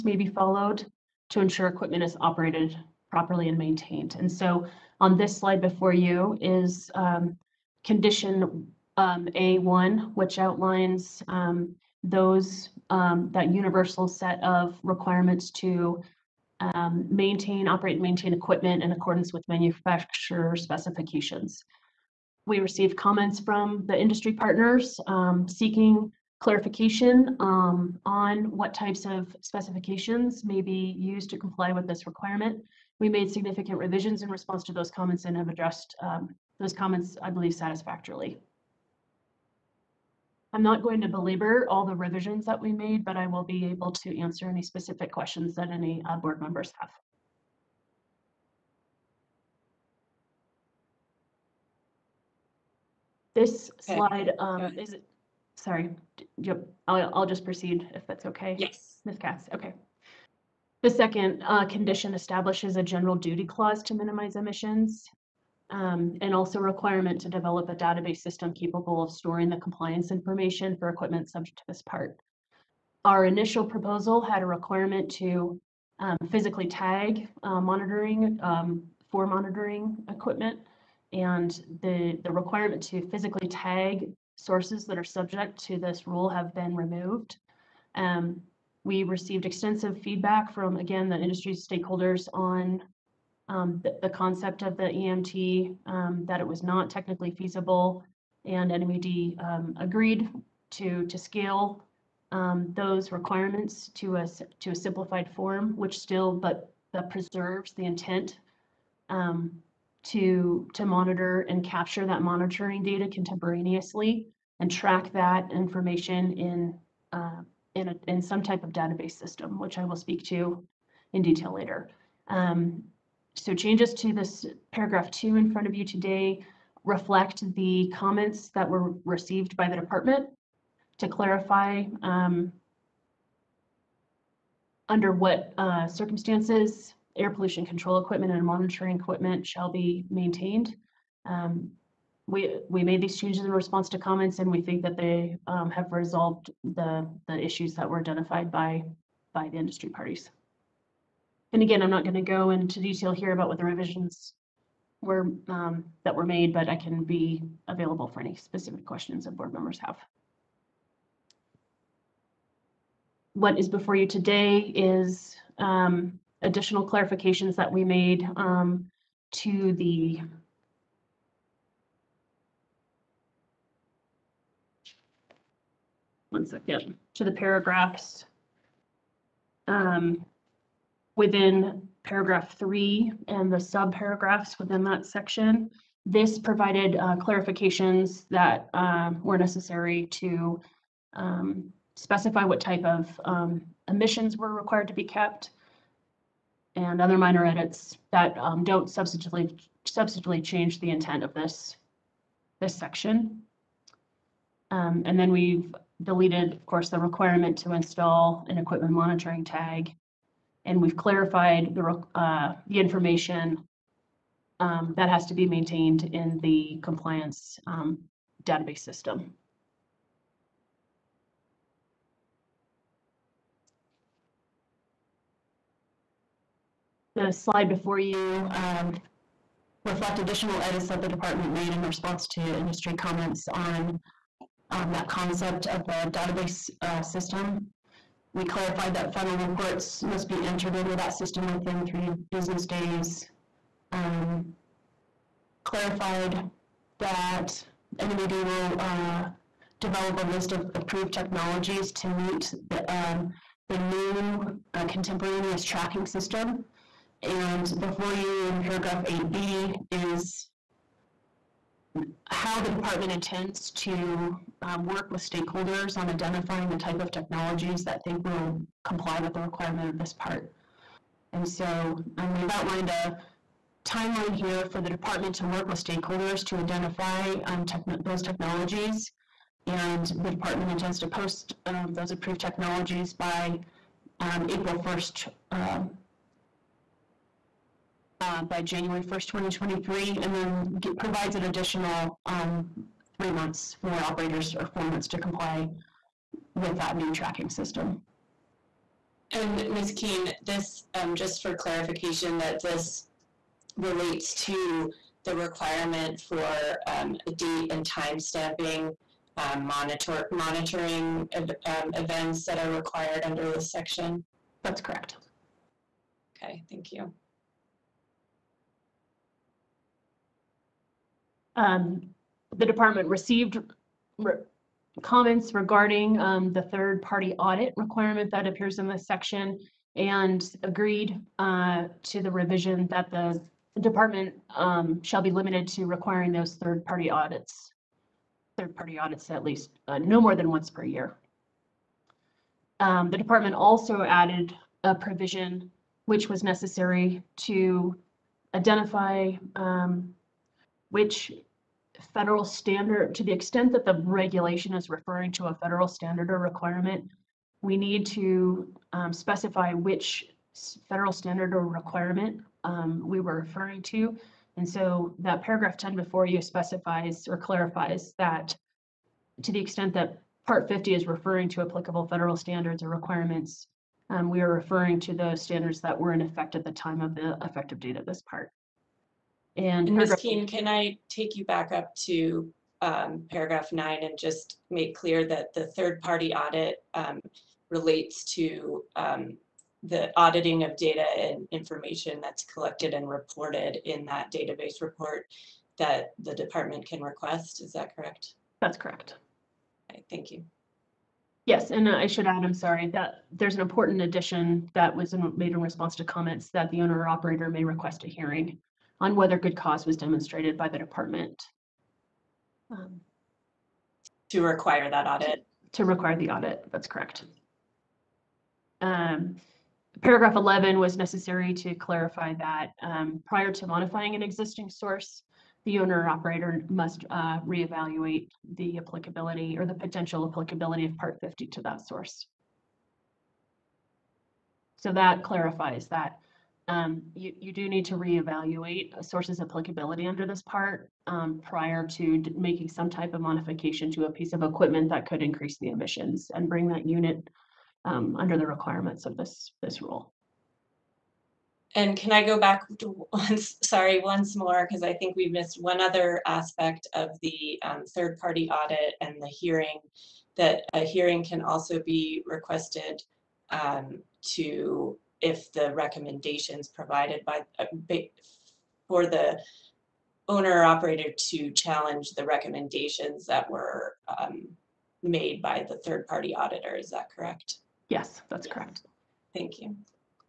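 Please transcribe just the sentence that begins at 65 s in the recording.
um, And also requirement to develop a database system capable of storing the compliance information for equipment subject to this part.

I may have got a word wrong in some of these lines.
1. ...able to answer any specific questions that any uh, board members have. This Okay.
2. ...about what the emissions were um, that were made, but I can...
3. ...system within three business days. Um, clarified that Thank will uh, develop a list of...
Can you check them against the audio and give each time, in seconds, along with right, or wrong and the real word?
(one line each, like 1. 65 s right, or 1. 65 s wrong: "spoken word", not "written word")
1. 43 s right
2. 153 s wrong: "revisions", not "emissions"
3. 241 s wrong: "NMED", not "Thank".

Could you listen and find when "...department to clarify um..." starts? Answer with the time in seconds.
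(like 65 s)
129 s.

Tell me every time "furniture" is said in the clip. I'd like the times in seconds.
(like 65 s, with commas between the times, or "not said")
not said.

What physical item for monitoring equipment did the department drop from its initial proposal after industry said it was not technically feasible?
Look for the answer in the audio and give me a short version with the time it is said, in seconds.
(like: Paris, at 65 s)
equipment monitoring tag, at 208 s.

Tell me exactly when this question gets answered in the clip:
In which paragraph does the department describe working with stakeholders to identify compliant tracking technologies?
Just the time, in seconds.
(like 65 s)
259 s.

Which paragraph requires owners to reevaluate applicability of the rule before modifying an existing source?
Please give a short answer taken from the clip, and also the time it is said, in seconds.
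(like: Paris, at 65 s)
11, at 420 s.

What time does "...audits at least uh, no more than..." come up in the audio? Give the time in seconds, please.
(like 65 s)
338 s.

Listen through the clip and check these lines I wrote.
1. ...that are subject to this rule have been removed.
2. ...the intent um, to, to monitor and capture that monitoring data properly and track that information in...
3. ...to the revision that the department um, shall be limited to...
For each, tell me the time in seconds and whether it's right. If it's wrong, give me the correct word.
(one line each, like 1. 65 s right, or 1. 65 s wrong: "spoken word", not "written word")
1. 84 s right
2. 107 s wrong: "contemporaneously", not "properly"
3. 332 s right.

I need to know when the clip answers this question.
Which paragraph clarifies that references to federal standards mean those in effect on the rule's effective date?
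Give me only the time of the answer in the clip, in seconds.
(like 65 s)
365 s.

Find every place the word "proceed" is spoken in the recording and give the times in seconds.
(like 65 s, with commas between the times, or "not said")
57 s.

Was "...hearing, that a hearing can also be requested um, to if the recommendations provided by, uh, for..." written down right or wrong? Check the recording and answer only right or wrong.
right.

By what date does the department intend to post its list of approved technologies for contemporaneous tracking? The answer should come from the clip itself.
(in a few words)
January 1st, 2023.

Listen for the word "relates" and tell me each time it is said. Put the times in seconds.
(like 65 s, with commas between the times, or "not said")
303 s, 387 s.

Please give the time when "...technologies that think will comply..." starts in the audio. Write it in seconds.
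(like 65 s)
267 s.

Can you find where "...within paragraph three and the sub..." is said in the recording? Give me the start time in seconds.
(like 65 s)
181 s.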